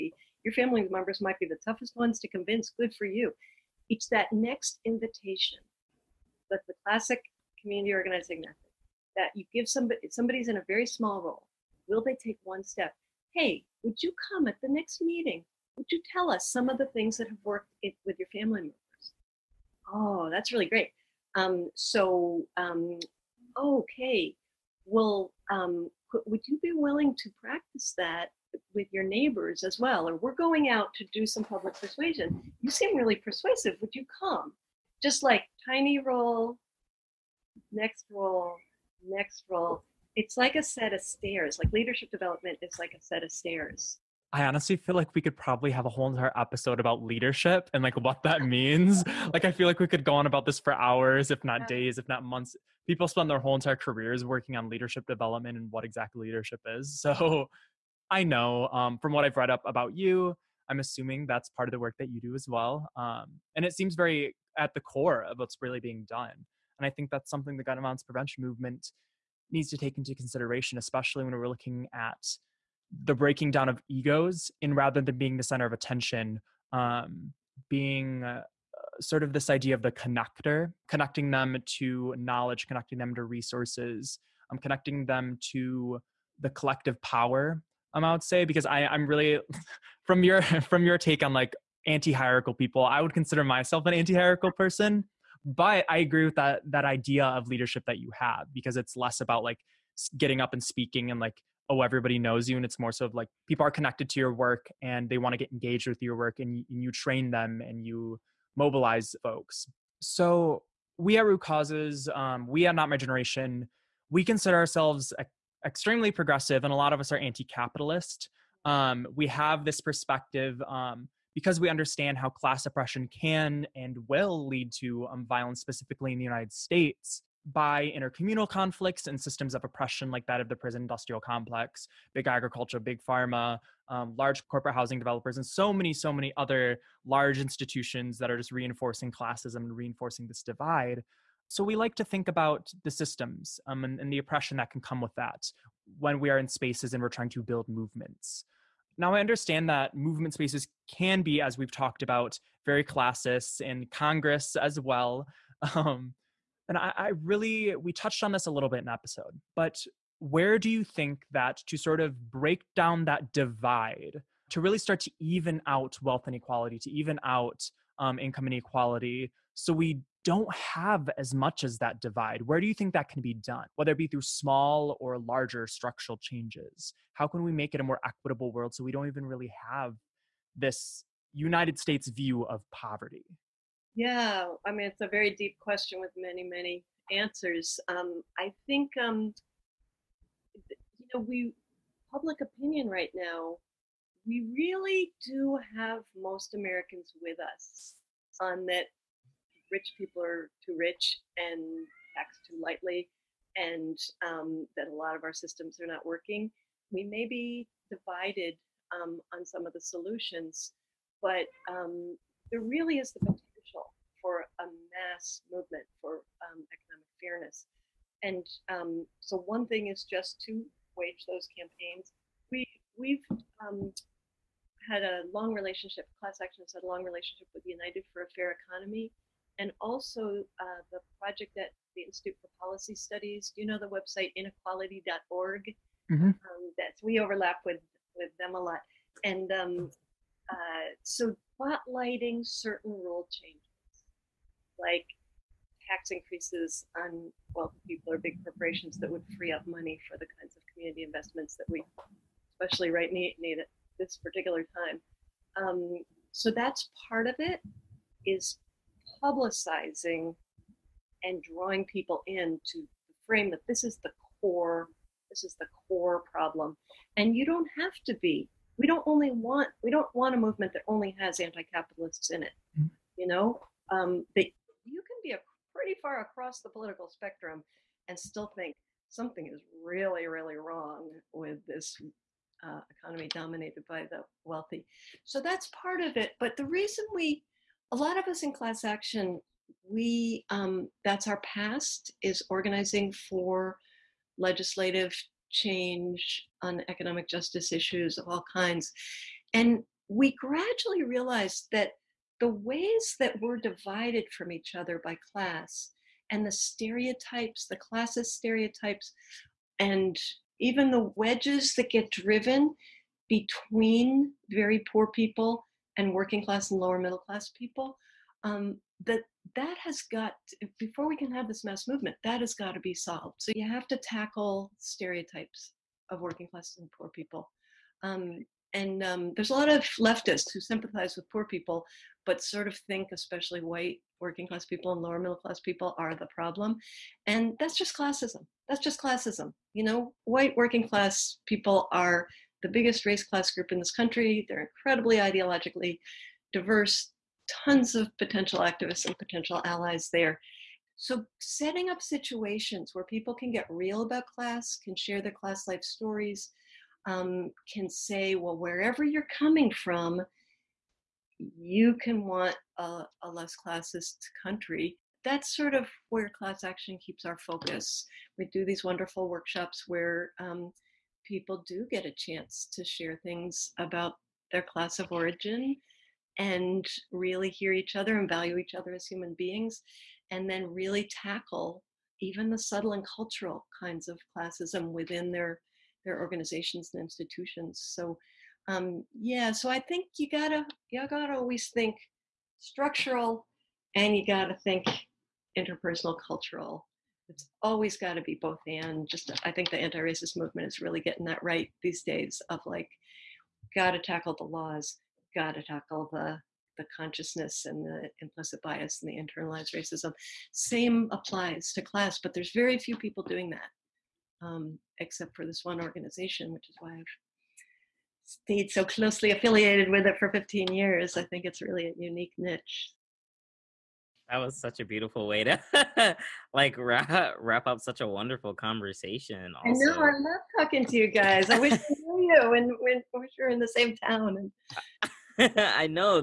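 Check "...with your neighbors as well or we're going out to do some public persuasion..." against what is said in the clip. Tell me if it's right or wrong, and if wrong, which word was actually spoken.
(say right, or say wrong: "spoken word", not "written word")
right.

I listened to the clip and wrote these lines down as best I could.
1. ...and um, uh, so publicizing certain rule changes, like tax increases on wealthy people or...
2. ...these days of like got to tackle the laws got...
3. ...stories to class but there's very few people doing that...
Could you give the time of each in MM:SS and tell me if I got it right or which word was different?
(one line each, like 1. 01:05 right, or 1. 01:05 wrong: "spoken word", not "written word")
1. 03:59 wrong: "spotlighting", not "publicizing"
2. 06:41 right
3. 06:51 wrong: "applies", not "stories".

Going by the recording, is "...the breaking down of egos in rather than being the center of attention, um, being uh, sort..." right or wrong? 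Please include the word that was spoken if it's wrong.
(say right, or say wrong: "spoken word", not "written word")
right.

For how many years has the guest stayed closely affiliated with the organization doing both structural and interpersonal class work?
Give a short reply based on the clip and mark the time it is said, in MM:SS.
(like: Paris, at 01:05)
15, at 07:00.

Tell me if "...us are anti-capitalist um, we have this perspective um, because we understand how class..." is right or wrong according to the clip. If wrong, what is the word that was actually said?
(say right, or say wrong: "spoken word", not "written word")
right.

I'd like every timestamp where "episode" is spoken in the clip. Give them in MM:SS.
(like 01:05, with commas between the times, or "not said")
00:46, 02:38.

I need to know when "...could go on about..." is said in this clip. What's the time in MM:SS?
00:49.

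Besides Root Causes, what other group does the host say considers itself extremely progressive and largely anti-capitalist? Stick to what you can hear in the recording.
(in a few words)
Not My Generation.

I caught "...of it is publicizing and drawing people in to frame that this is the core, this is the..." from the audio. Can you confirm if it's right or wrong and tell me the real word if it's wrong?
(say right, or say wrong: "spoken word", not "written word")
right.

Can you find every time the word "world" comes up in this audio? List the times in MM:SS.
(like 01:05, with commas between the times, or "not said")
02:58.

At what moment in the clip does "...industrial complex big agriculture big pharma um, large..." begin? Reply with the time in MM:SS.
02:10.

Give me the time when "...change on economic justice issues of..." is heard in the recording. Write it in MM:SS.
04:55.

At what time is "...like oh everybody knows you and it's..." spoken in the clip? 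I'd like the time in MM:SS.
01:41.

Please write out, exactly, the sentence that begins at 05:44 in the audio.
They're incredibly ideologically diverse, tons of potential activists and potential allies there.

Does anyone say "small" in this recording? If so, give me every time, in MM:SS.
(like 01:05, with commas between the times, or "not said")
00:10, 02:54.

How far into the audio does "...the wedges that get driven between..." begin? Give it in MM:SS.
05:10.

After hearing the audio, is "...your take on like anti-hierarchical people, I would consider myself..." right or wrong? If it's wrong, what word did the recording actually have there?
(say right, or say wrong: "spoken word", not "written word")
right.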